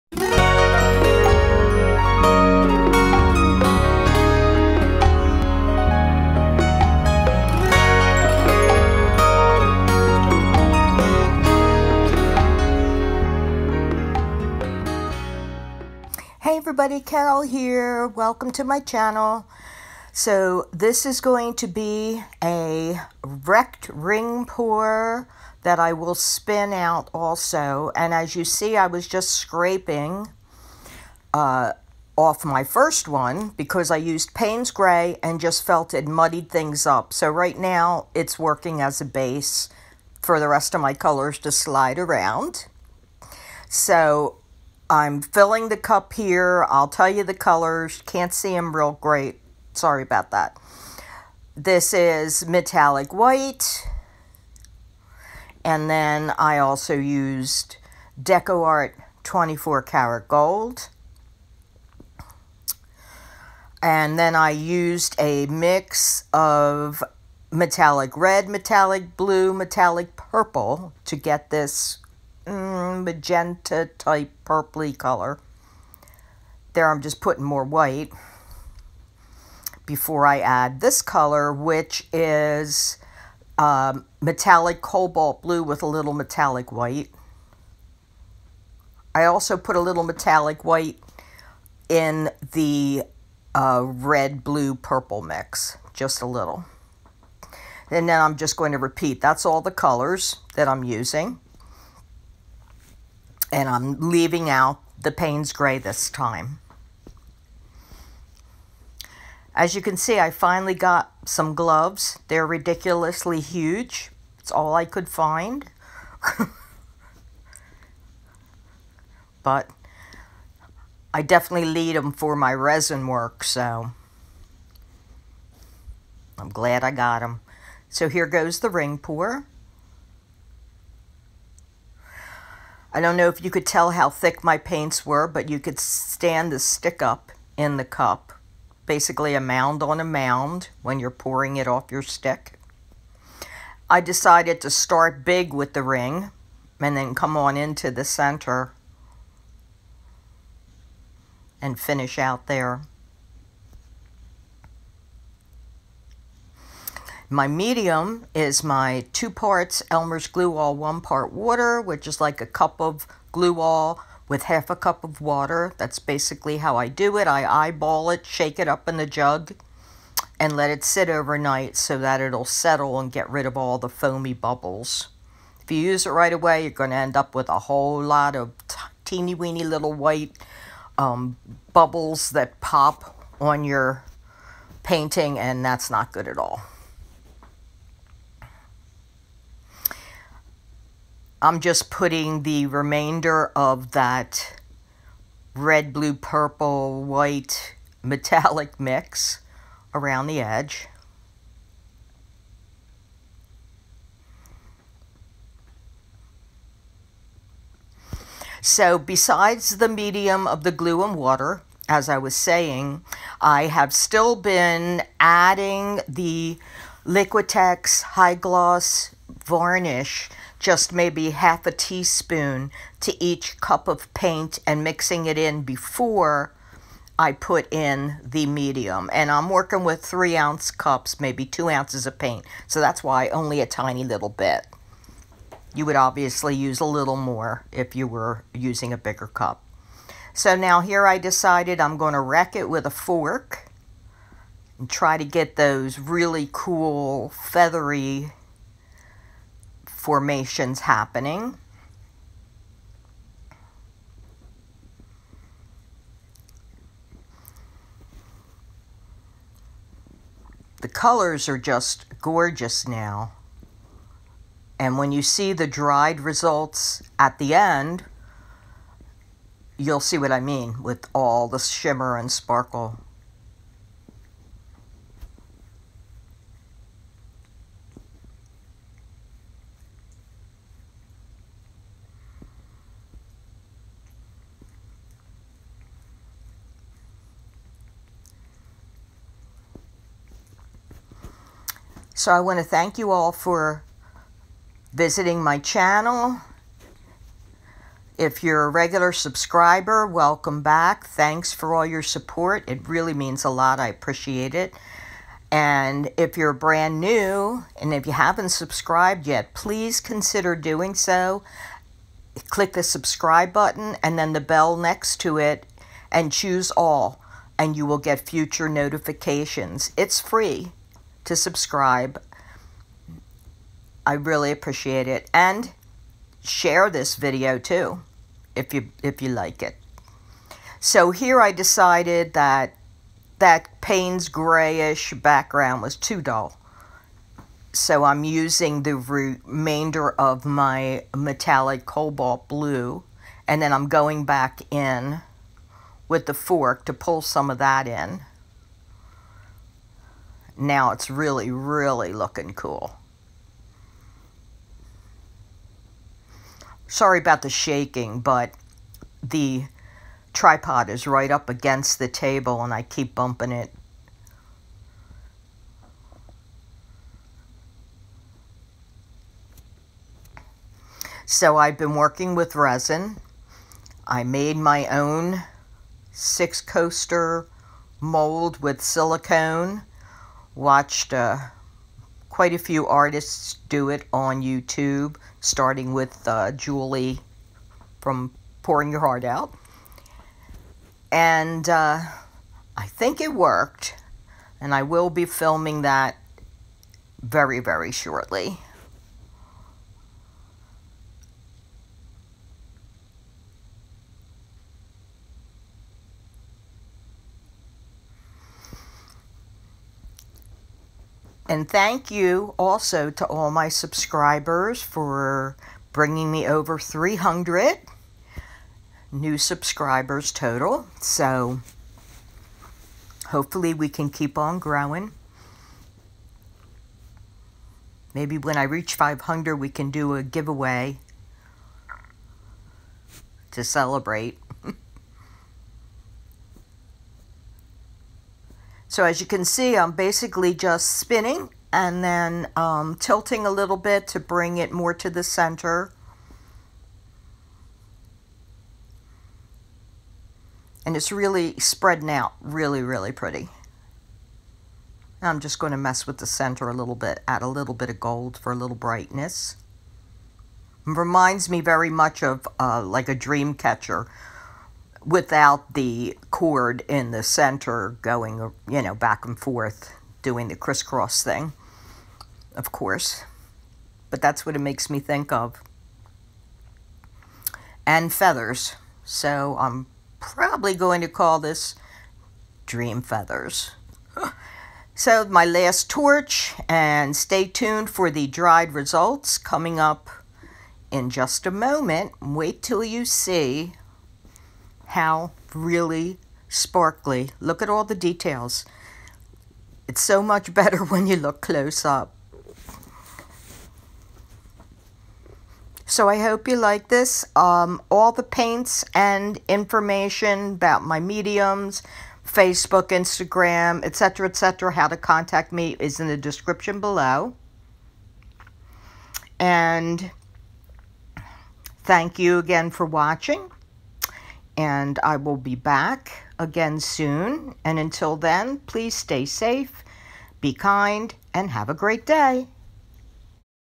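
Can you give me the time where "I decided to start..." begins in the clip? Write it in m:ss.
2:23.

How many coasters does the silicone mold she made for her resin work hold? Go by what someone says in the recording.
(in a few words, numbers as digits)
6.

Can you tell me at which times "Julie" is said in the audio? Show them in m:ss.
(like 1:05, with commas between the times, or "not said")
6:26.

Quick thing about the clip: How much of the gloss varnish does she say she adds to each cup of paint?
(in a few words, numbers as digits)
half a teaspoon.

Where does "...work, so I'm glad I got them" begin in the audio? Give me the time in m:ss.
2:03.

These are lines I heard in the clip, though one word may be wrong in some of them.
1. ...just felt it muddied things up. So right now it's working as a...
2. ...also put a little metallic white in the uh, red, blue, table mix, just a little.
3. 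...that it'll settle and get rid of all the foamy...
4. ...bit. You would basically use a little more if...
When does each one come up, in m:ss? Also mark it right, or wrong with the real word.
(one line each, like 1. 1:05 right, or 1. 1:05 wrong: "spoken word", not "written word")
1. 0:35 right
2. 1:29 wrong: "purple", not "table"
3. 2:51 right
4. 3:54 wrong: "obviously", not "basically".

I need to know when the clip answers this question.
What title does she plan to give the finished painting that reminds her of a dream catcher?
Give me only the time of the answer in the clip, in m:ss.
8:02.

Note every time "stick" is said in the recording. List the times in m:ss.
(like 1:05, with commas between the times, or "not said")
2:16, 2:22.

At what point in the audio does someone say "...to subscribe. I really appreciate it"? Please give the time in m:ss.
5:21.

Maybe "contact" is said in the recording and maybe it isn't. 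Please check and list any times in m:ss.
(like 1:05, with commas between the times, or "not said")
8:34.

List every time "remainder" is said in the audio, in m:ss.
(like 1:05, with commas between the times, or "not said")
3:12, 5:38.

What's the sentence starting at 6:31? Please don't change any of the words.
And uh, I think it worked, and I will be filming that very, very shortly.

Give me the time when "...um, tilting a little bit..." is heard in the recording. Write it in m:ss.
7:22.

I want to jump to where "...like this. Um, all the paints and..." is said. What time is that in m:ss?
8:26.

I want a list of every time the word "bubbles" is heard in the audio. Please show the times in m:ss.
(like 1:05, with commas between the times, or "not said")
2:54, 3:01.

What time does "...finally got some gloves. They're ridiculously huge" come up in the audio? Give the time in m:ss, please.
1:50.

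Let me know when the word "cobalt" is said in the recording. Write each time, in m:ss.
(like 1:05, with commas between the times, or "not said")
1:24, 5:41.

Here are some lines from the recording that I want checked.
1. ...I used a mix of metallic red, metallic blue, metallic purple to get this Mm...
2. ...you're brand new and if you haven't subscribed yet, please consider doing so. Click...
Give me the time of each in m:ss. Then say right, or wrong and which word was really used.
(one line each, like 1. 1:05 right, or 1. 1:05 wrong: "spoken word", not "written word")
1. 1:04 right
2. 5:06 right.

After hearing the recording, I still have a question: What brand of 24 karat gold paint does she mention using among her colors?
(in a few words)
DecoArt.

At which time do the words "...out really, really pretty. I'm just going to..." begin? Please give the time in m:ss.
7:32.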